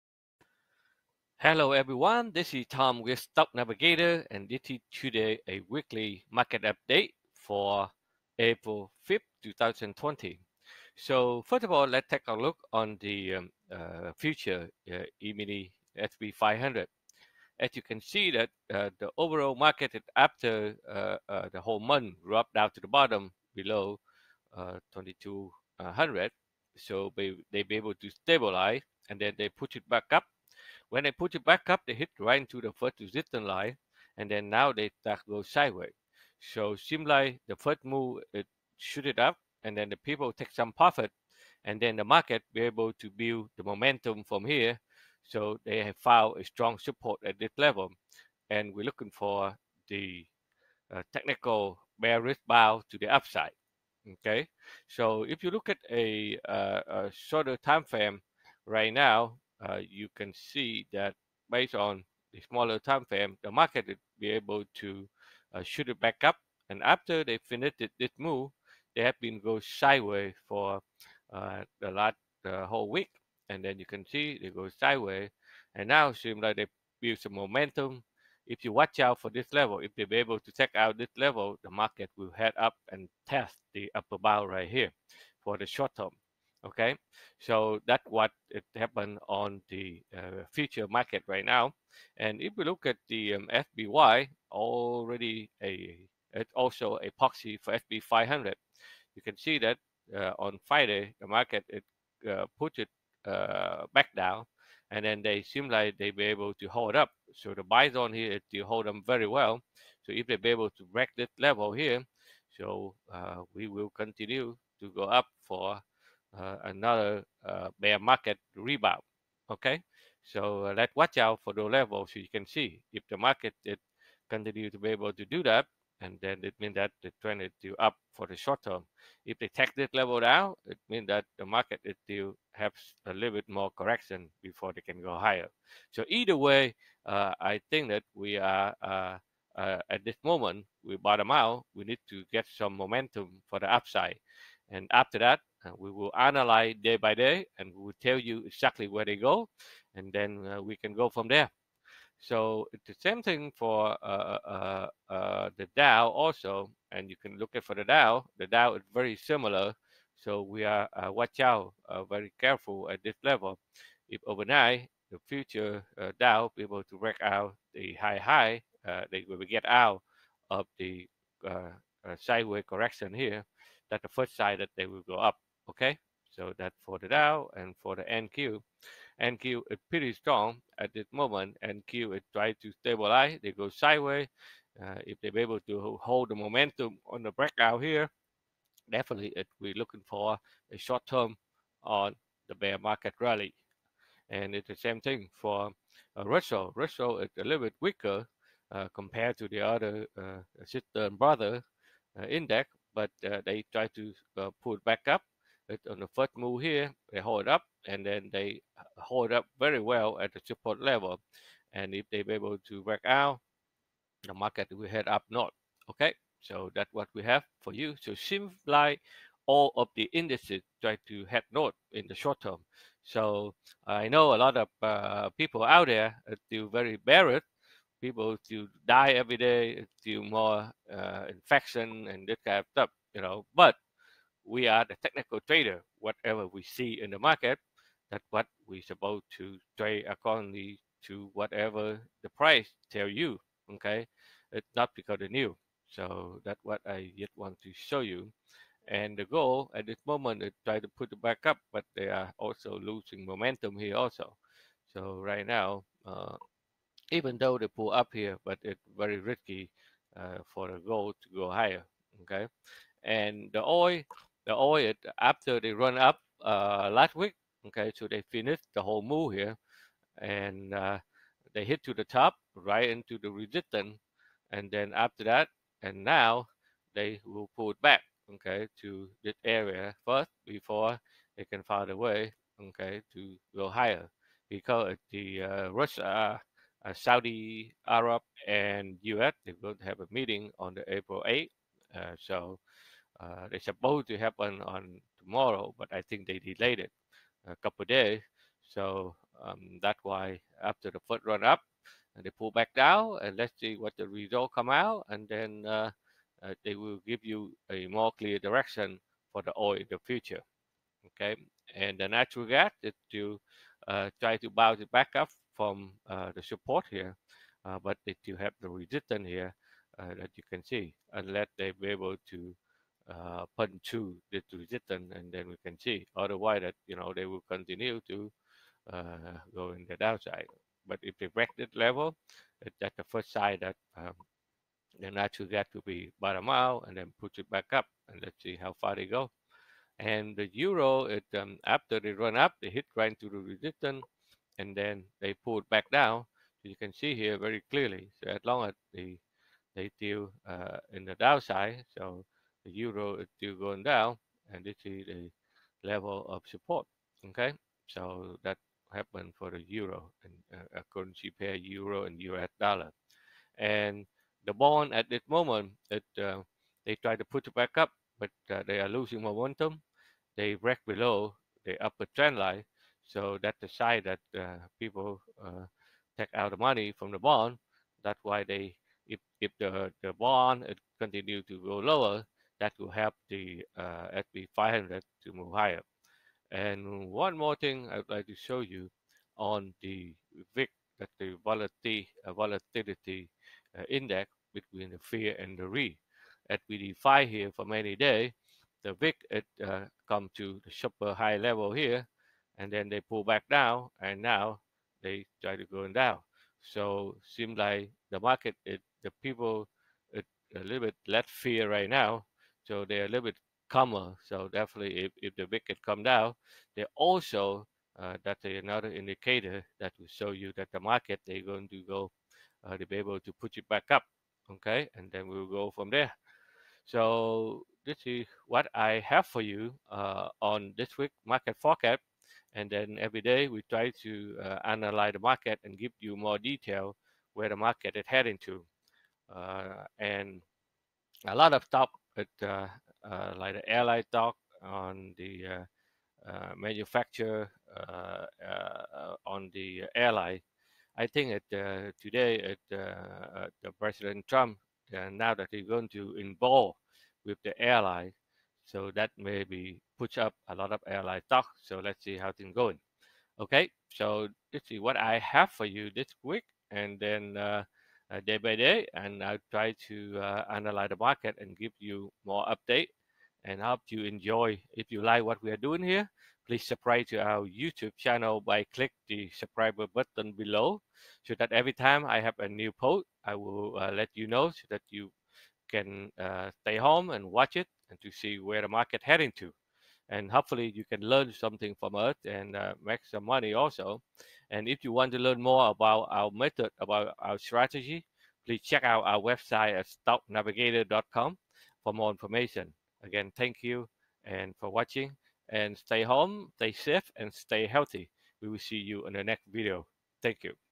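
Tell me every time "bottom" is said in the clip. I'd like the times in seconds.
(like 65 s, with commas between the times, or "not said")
22 s, 140 s, 336 s.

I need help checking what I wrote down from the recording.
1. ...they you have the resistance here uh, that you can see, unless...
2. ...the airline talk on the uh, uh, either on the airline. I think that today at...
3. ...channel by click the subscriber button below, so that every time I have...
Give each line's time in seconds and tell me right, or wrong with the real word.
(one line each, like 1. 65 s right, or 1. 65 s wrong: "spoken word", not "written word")
1. 318 s right
2. 443 s wrong: "manufacturer", not "either"
3. 477 s right.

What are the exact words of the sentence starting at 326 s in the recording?
Otherwise, that you know they will continue to go in the downside.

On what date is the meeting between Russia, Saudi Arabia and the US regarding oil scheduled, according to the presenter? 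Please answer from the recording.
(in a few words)
April 8th.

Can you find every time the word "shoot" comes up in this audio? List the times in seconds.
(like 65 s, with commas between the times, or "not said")
38 s, 65 s.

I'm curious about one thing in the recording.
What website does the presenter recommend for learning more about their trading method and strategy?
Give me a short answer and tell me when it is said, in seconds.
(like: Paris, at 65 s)
stocknavigator.com, at 500 s.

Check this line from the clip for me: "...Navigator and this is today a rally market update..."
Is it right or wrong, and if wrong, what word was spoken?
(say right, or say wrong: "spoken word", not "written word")
wrong: "weekly", not "rally".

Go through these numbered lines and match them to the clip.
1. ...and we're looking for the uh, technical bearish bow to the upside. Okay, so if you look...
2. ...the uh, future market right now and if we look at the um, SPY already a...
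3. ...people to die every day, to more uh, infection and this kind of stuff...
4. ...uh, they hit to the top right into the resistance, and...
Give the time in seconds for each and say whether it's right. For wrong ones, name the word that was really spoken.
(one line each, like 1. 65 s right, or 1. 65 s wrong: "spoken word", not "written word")
1. 48 s right
2. 89 s right
3. 228 s right
4. 270 s right.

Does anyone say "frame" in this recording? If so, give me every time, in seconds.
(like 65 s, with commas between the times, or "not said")
57 s, 63 s.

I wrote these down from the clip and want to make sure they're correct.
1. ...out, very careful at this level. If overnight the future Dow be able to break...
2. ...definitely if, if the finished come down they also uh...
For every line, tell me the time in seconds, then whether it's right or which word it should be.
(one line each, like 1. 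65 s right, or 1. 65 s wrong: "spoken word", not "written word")
1. 161 s right
2. 414 s wrong: "wicked", not "finished".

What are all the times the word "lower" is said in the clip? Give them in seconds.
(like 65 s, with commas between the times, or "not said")
381 s.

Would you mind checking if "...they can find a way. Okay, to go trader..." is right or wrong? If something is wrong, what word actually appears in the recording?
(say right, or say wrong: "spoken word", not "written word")
wrong: "higher", not "trader".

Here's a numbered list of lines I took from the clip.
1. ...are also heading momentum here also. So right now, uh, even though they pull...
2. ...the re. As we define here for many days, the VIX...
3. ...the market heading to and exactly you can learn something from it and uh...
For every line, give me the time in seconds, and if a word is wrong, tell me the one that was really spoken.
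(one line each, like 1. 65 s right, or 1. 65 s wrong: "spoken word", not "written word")
1. 252 s wrong: "losing", not "heading"
2. 395 s right
3. 488 s wrong: "hopefully", not "exactly".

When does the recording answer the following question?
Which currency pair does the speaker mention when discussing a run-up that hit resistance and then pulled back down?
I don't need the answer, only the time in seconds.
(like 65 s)
361 s.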